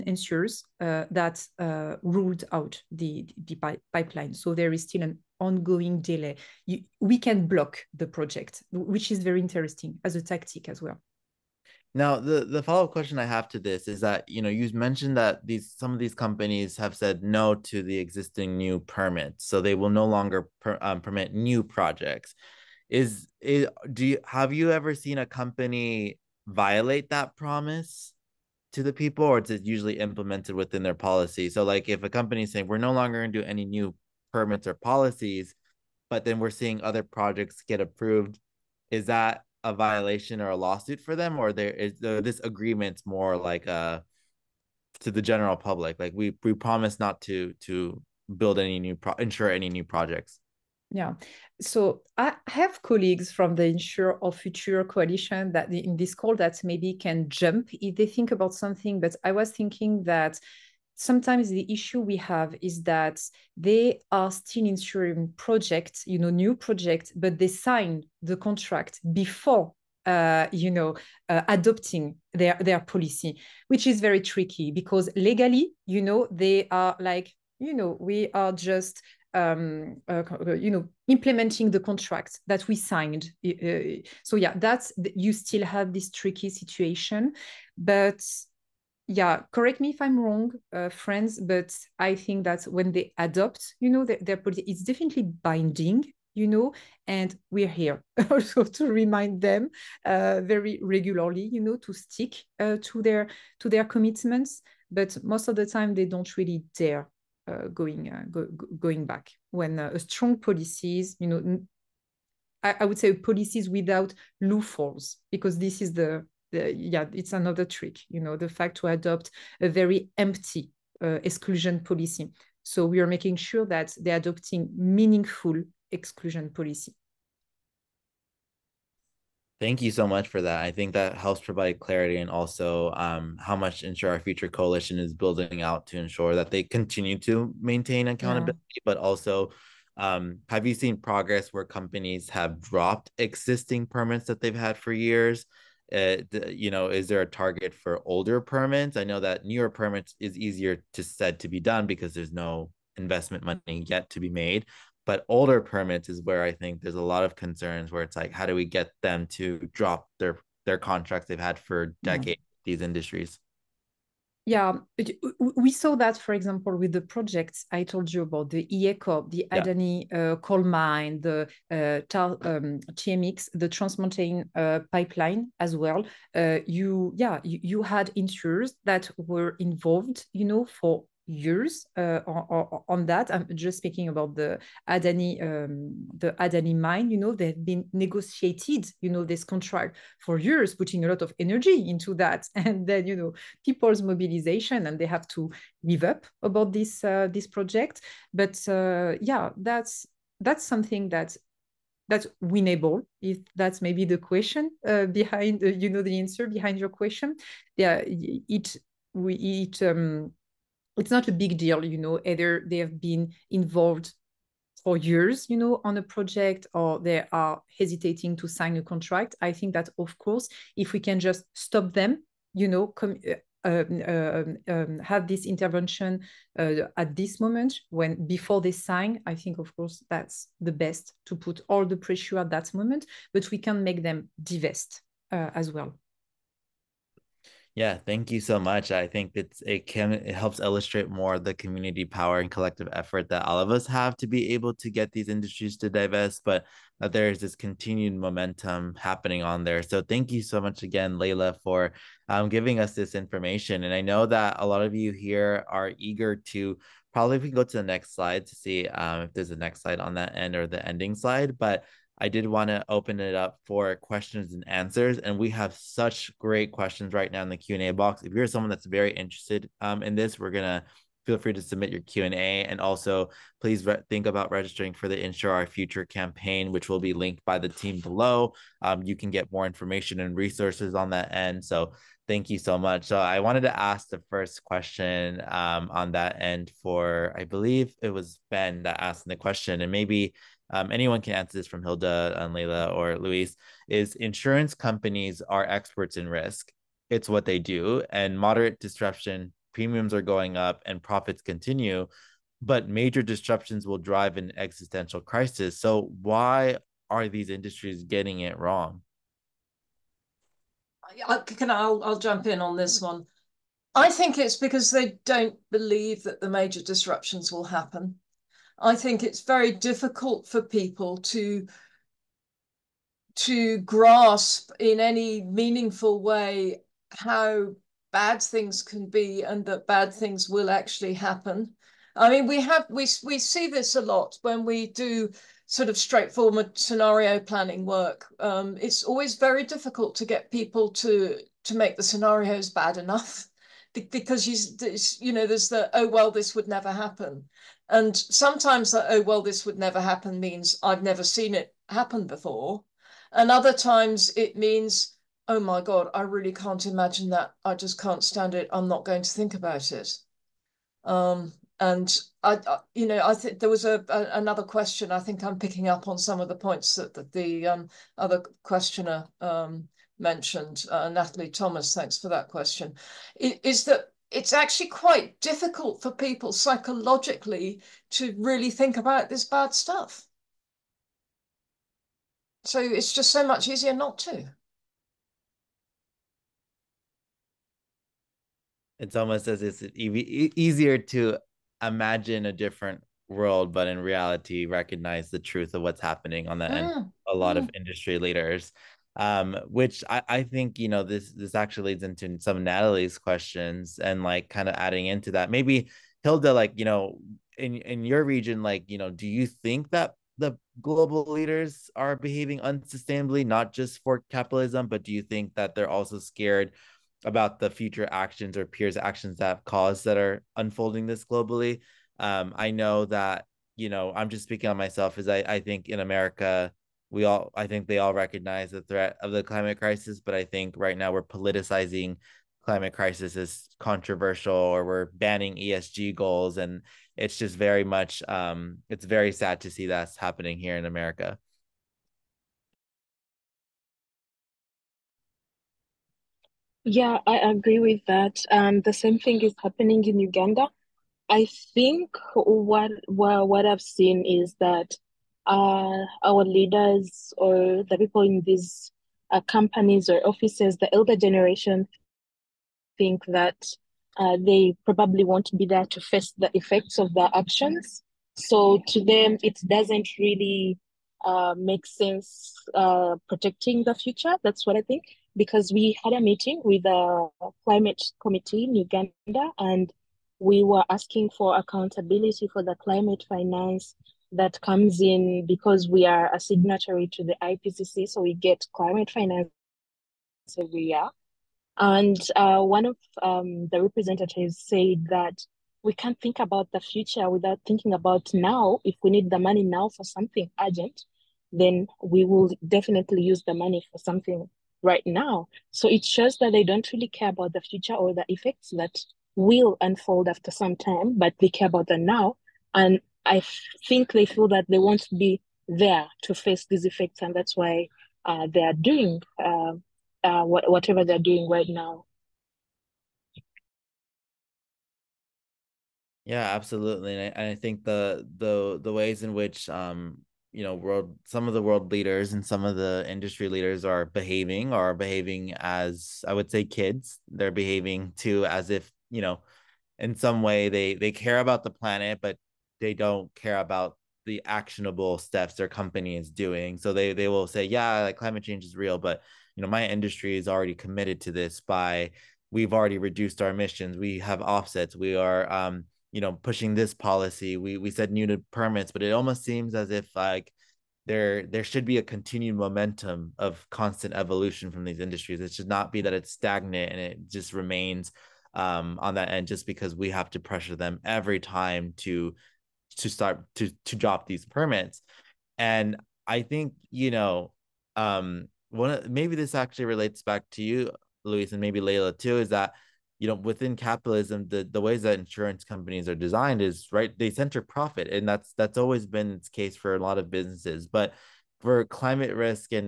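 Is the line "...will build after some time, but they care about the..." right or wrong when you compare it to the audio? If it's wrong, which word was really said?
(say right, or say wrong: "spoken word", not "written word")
wrong: "unfold", not "build".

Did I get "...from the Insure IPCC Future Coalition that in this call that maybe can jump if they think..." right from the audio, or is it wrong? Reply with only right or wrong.
wrong.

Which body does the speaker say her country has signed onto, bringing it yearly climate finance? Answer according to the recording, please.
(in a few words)
IPCC.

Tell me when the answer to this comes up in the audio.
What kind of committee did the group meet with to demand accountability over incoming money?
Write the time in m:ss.
7:57.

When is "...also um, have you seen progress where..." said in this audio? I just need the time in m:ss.
2:18.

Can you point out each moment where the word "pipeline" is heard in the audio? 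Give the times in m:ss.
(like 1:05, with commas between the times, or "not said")
0:03, 2:54.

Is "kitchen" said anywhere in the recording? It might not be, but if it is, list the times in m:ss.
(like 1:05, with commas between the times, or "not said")
not said.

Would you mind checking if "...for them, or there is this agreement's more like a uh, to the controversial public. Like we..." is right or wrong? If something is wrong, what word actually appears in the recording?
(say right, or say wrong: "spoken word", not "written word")
wrong: "general", not "controversial".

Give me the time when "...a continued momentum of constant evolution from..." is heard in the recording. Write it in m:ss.
9:21.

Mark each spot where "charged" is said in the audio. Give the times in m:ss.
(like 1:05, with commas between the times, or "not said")
not said.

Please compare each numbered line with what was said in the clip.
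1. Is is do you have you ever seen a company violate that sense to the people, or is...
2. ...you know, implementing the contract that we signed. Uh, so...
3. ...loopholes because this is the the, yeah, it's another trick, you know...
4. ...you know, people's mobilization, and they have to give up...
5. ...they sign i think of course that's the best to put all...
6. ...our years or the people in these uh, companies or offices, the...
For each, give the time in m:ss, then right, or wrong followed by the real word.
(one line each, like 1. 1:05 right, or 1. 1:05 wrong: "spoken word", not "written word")
1. 0:22 wrong: "promise", not "sense"
2. 1:20 right
3. 1:54 right
4. 3:13 right
5. 3:48 right
6. 7:36 wrong: "leaders", not "years".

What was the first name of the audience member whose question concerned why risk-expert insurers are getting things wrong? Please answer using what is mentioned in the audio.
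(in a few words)
Ben.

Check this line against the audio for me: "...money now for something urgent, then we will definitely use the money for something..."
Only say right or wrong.
right.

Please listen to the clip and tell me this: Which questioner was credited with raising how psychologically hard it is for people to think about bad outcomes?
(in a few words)
Natalie Thomas.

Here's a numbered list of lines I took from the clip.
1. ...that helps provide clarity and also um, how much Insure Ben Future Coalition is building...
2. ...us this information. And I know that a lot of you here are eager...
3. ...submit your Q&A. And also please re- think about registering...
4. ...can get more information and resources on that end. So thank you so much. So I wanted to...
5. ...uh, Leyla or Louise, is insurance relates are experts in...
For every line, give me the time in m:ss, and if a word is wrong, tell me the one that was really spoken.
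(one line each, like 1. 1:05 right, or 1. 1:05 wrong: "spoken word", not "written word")
1. 2:10 wrong: "Our", not "Ben"
2. 4:12 right
3. 4:31 right
4. 4:39 right
5. 4:52 wrong: "companies", not "relates".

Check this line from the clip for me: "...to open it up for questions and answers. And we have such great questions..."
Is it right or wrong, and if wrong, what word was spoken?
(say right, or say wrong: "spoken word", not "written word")
right.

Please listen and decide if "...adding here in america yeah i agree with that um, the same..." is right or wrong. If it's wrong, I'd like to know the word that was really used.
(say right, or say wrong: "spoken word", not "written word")
wrong: "happening", not "adding".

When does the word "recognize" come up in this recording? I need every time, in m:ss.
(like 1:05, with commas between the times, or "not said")
6:34, 7:08.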